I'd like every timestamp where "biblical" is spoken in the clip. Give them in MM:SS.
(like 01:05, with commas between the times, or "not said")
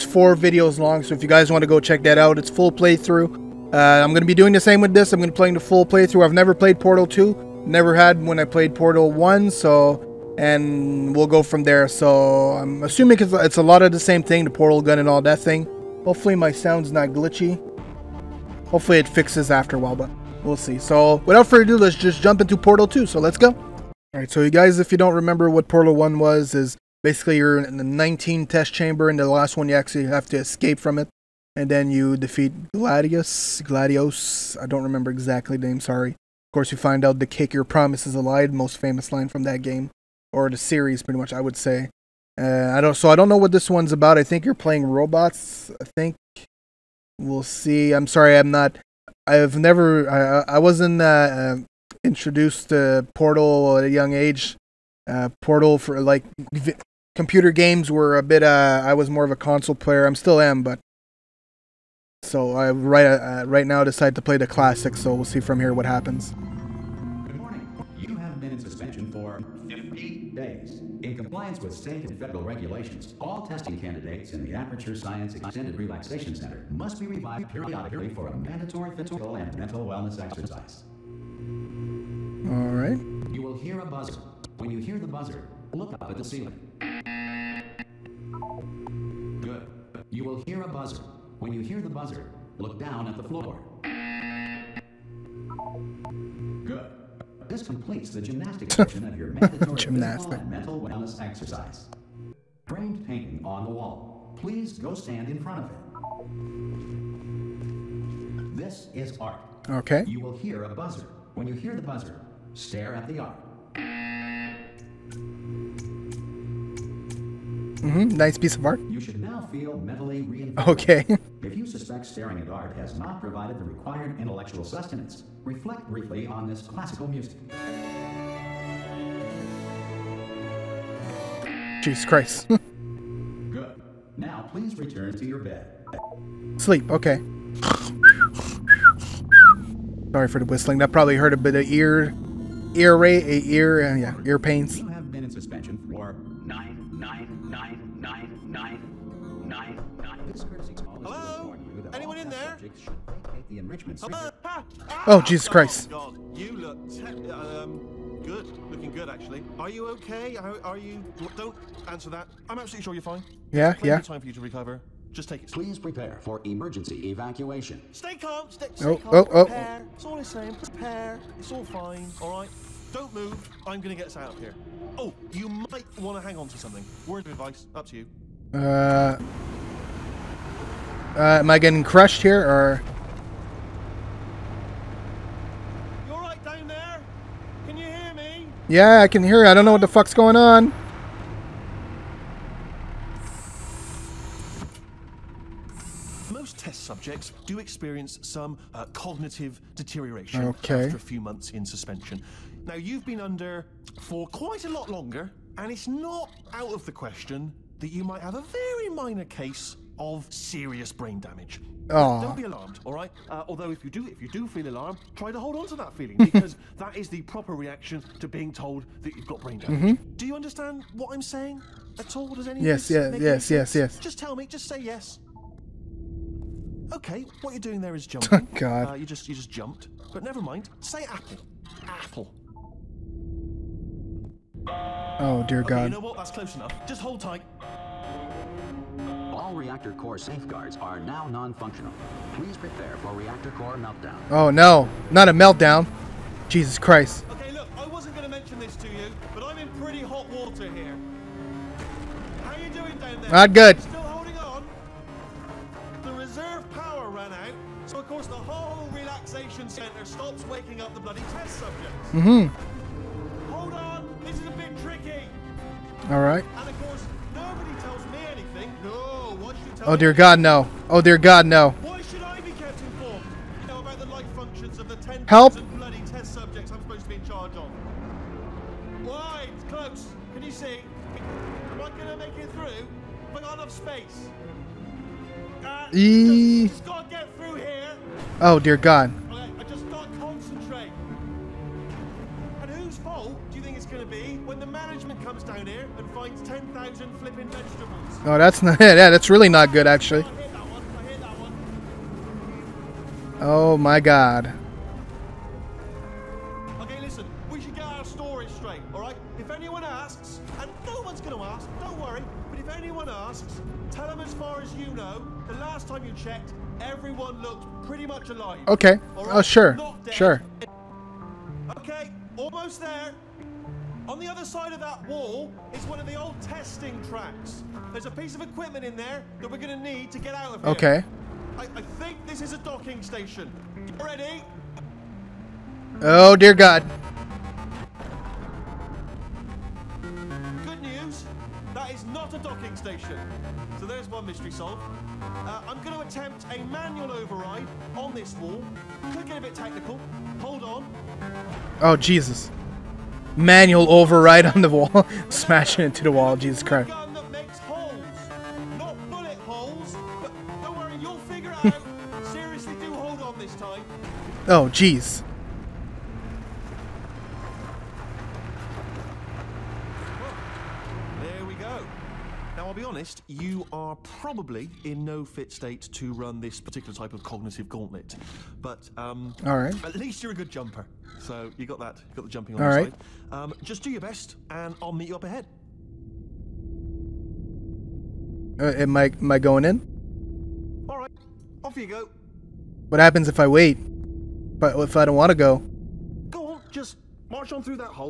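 not said.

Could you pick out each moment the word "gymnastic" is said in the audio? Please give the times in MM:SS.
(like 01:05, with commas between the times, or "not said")
01:38.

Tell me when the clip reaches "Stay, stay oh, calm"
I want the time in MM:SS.
02:48.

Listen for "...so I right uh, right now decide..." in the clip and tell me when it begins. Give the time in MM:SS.
01:02.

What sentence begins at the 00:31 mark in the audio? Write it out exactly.
And then you defeat Gladius, Gladios, I don't remember exactly the name, sorry.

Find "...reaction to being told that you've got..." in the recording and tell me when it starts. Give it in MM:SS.
03:37.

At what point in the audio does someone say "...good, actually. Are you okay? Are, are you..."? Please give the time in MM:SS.
02:38.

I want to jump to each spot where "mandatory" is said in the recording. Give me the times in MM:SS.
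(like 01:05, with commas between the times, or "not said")
01:18, 01:39.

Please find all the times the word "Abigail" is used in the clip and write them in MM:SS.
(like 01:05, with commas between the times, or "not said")
not said.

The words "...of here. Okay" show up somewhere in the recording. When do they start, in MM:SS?
05:30.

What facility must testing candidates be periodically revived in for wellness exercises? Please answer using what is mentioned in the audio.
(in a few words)
Aperture Science Extended Relaxation Center.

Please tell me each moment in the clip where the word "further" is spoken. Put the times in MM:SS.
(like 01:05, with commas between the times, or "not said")
00:21.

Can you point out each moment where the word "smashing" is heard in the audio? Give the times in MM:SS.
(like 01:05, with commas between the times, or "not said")
05:55.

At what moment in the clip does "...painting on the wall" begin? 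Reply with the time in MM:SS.
01:43.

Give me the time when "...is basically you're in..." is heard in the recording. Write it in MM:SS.
00:26.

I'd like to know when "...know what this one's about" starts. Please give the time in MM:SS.
00:43.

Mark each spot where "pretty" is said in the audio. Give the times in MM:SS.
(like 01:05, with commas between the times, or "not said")
00:41, 04:09, 05:17.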